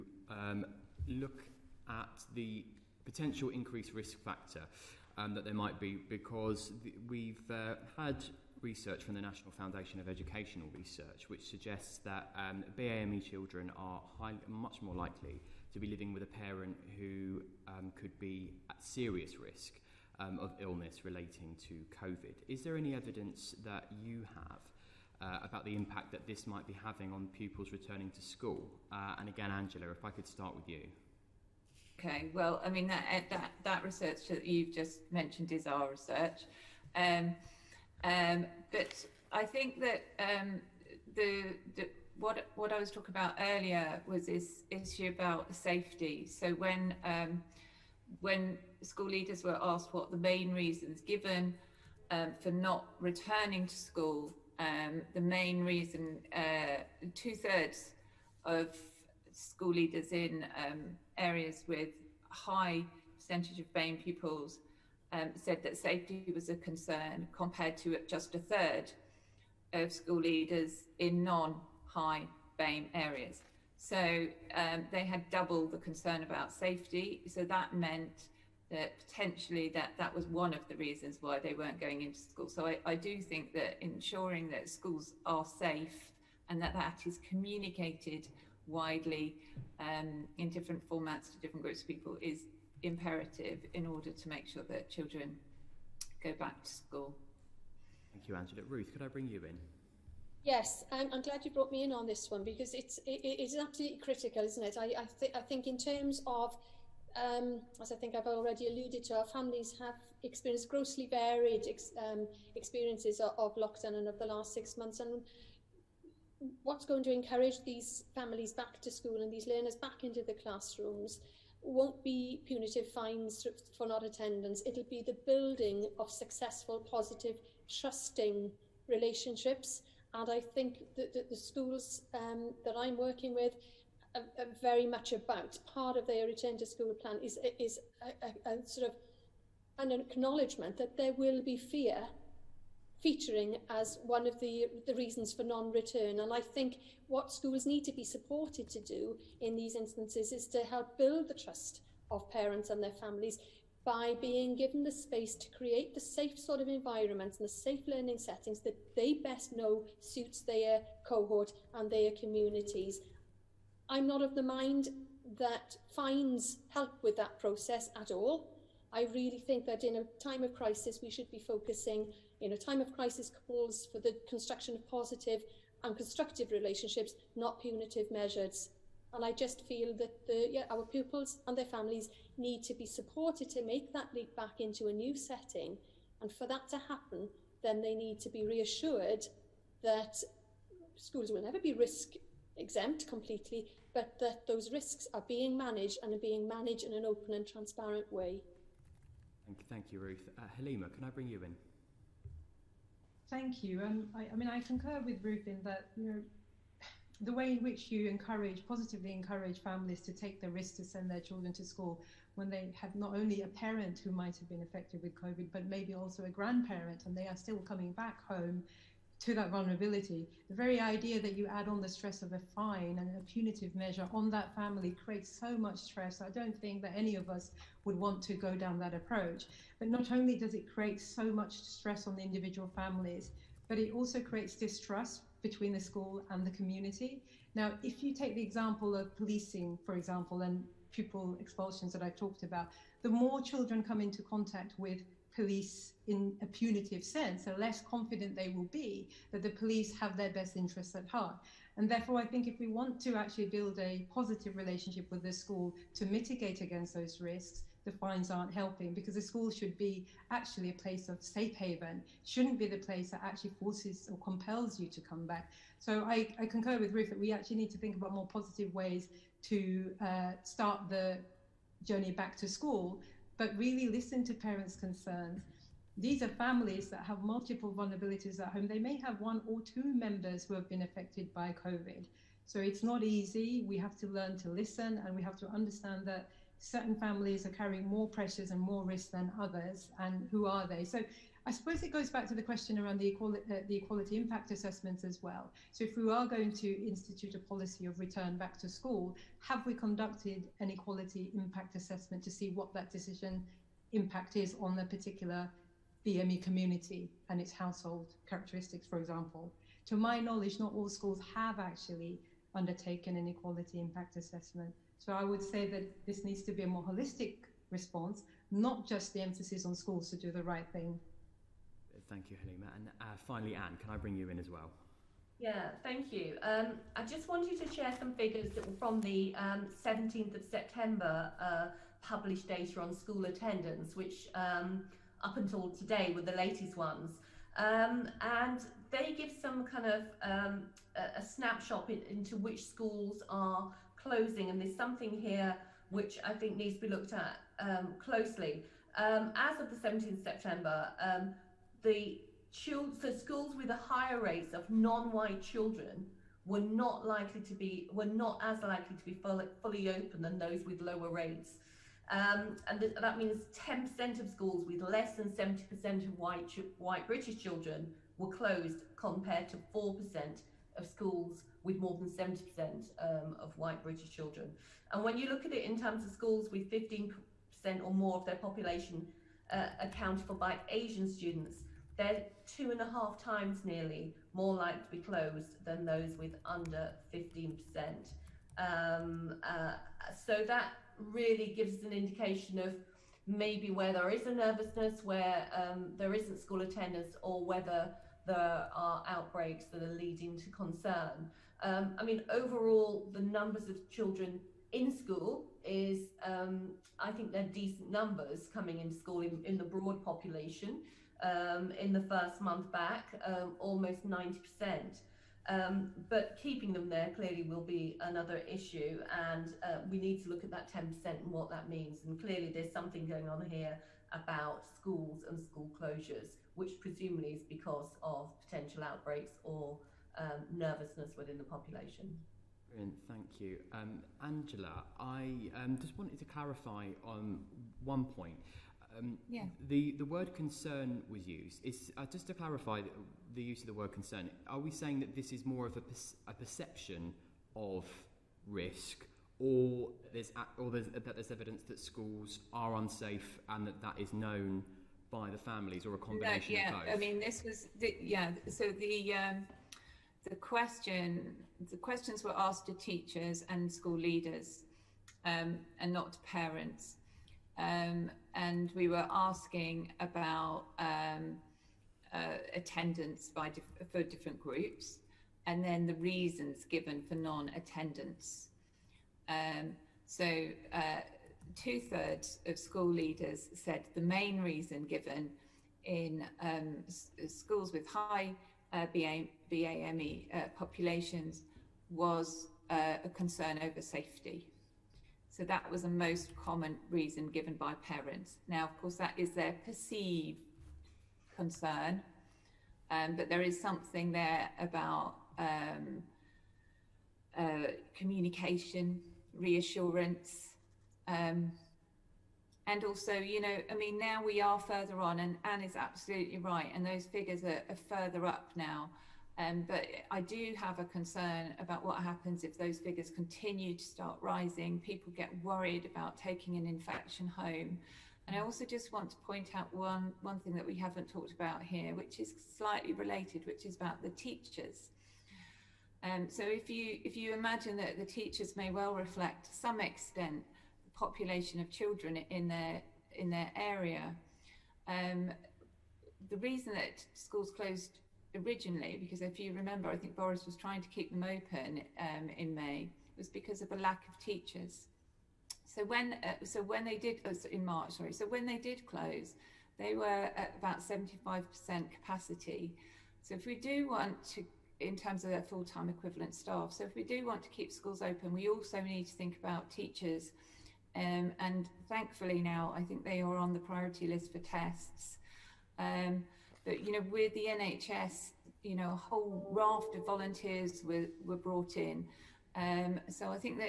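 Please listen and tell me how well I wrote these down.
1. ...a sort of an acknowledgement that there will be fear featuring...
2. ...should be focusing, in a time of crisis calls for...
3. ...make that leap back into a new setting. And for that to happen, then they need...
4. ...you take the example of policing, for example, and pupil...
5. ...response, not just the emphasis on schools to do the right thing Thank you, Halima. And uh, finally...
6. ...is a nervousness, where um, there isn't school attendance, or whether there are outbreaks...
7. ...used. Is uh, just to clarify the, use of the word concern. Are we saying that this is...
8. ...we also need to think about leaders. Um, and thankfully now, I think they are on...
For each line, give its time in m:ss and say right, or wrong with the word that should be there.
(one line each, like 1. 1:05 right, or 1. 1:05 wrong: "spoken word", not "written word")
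1. 2:18 right
2. 2:51 right
3. 3:03 right
4. 3:58 right
5. 5:17 right
6. 6:34 right
7. 7:21 right
8. 9:28 wrong: "teachers", not "leaders".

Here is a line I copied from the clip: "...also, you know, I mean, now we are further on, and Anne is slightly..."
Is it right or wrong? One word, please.
wrong.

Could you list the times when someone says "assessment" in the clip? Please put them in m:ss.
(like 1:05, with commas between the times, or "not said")
4:54, 5:01, 5:14.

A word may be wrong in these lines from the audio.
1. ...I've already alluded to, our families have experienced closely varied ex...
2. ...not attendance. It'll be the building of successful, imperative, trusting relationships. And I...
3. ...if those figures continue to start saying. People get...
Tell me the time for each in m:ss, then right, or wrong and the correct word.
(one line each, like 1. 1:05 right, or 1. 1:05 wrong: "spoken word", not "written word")
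1. 1:48 wrong: "grossly", not "closely"
2. 2:03 wrong: "positive", not "imperative"
3. 8:42 wrong: "rising", not "saying".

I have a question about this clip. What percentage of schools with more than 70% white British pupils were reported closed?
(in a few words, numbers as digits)
4%.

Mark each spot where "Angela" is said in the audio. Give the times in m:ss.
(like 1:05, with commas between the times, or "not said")
0:29, 1:38, 7:14.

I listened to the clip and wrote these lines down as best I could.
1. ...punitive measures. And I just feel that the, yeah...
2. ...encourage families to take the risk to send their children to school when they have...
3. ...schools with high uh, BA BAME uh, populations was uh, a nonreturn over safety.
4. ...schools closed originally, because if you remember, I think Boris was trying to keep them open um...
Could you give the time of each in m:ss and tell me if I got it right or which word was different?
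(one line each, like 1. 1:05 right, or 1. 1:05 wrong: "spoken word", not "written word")
1. 2:57 right
2. 3:29 right
3. 8:07 wrong: "concern", not "nonreturn"
4. 9:07 right.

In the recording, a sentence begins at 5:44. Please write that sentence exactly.
And there's something here which I think needs to be looked at um, closely.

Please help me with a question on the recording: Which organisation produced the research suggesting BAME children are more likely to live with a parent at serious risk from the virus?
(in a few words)
National Foundation of Educational Research.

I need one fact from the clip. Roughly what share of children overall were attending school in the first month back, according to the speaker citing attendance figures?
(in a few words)
almost 90%.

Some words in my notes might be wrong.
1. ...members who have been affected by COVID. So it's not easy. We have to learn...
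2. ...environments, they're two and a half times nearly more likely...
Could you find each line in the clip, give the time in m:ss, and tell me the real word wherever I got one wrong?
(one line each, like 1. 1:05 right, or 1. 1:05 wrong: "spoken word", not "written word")
1. 4:39 right
2. 6:21 wrong: "students", not "environments".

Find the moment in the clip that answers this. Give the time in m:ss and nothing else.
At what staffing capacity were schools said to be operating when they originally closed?
9:20.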